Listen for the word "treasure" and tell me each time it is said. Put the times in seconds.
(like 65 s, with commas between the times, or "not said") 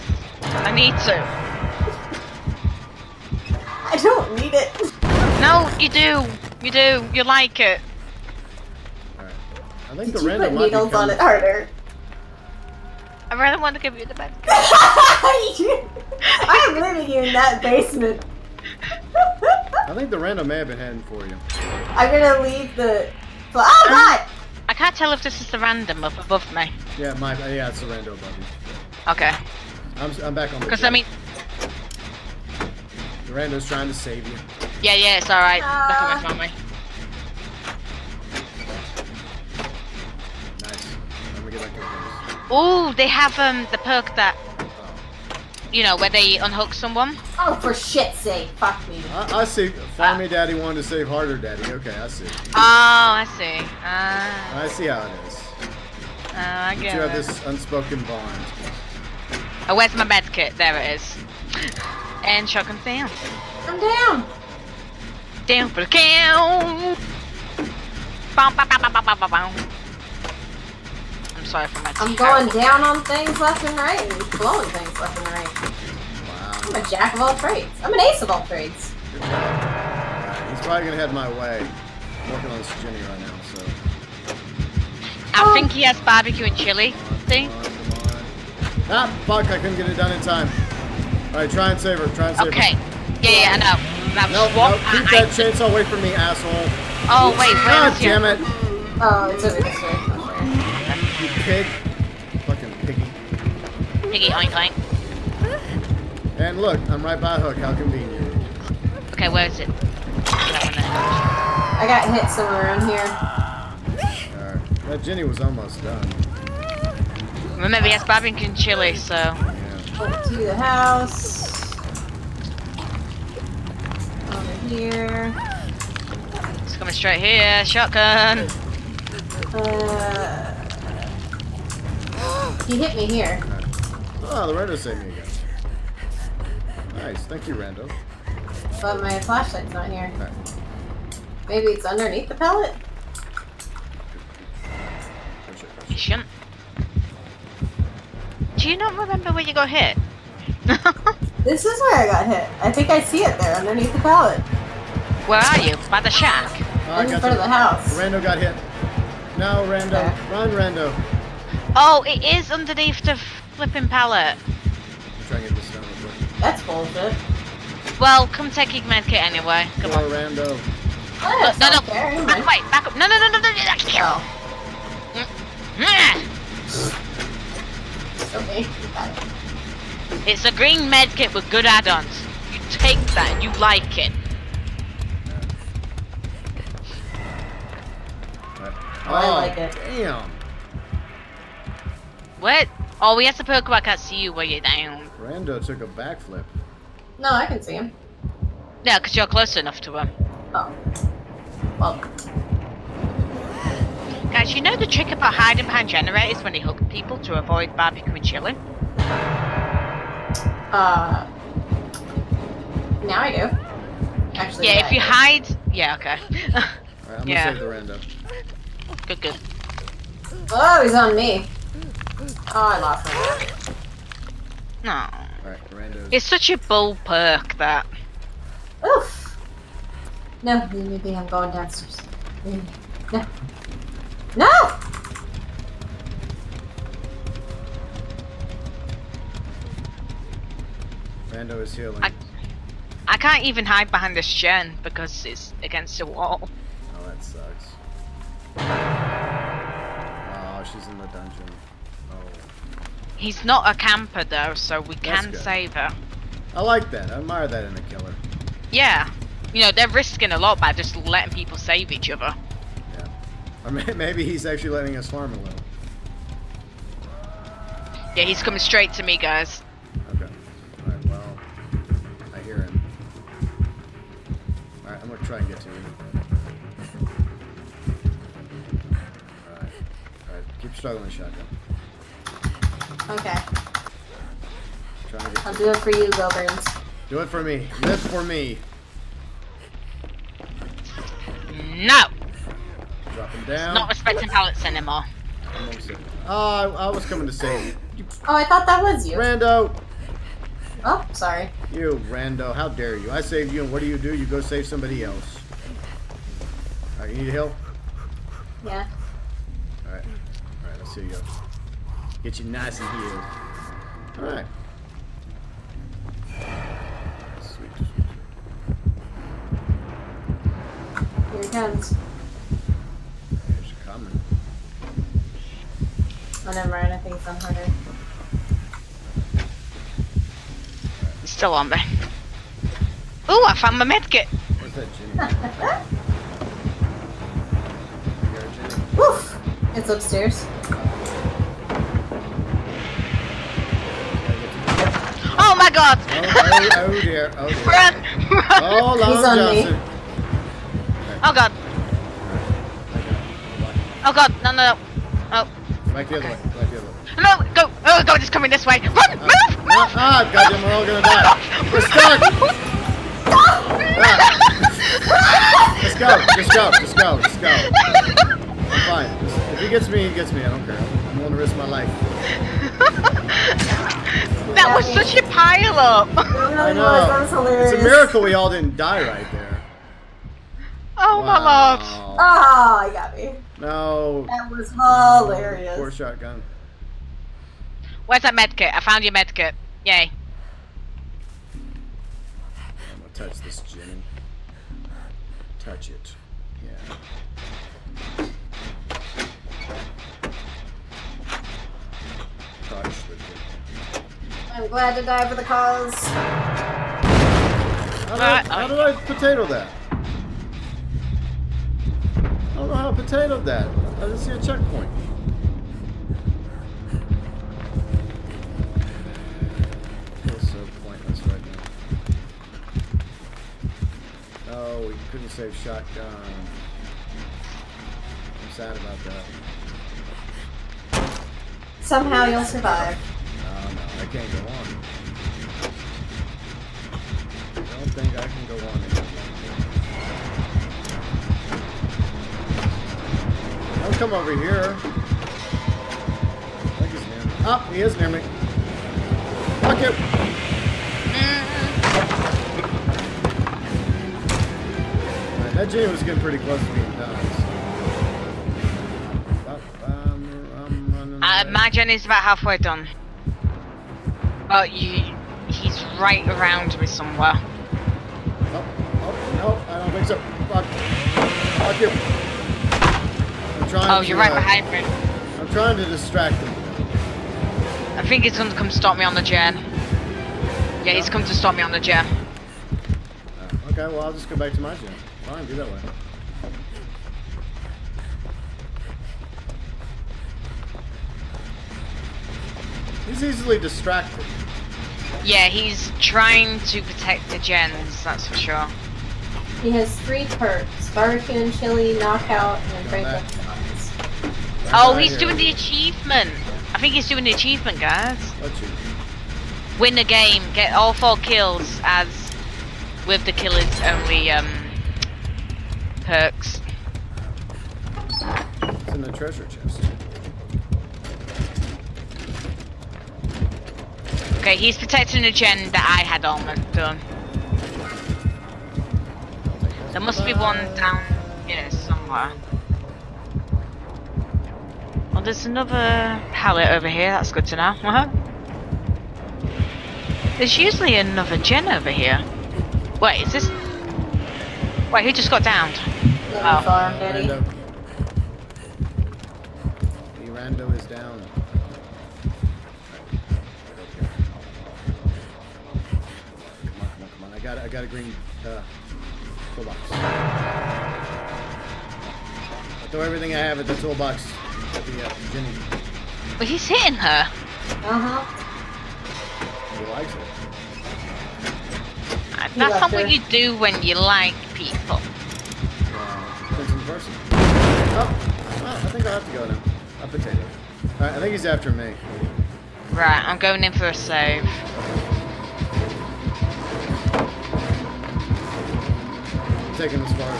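519 s.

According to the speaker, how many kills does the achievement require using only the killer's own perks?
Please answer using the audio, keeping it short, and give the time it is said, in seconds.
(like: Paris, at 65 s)
4, at 510 s.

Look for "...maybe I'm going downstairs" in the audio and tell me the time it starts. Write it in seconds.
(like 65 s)
230 s.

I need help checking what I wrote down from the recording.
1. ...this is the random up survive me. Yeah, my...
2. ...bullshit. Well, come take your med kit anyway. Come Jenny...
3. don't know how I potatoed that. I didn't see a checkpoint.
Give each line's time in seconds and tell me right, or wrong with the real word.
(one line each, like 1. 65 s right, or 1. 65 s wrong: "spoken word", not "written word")
1. 25 s wrong: "above", not "survive"
2. 166 s wrong: "Poor", not "Jenny"
3. 412 s right.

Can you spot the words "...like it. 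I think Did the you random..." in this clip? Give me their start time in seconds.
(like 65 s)
7 s.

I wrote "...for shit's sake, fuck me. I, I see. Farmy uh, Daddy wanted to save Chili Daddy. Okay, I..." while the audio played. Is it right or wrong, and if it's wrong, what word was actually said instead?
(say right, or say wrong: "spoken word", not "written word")
wrong: "Harder", not "Chili".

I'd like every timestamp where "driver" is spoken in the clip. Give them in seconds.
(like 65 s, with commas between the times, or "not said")
not said.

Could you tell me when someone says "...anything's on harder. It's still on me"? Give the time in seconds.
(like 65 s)
326 s.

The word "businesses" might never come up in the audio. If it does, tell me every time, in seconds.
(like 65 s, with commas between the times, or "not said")
not said.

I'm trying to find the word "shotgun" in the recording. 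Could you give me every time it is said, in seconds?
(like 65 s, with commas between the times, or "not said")
62 s, 127 s, 281 s, 385 s, 425 s.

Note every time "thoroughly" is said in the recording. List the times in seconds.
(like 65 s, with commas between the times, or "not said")
not said.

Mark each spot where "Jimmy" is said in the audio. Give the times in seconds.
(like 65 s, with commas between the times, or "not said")
82 s, 334 s.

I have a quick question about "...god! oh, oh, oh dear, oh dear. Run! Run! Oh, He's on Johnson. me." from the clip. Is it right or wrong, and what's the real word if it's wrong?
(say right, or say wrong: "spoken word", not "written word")
right.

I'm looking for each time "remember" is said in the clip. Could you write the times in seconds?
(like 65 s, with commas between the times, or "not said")
117 s, 148 s.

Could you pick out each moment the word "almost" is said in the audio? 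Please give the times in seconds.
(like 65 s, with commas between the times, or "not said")
115 s.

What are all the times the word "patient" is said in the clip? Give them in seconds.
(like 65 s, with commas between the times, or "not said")
145 s.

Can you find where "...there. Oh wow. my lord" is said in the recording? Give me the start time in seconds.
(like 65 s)
379 s.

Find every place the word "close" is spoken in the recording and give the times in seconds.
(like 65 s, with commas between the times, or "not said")
199 s, 456 s.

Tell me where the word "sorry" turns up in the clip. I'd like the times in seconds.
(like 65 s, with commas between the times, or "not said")
71 s, 301 s.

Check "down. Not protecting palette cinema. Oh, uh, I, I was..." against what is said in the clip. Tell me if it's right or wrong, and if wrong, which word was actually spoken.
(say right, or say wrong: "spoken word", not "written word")
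wrong: "respecting", not "protecting".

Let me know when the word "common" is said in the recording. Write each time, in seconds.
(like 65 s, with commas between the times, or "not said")
not said.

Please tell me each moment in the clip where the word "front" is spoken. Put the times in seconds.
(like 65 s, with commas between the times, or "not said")
157 s.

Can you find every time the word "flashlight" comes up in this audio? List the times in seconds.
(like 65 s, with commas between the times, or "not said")
139 s.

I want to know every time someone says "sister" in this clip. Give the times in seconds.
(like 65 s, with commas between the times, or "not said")
not said.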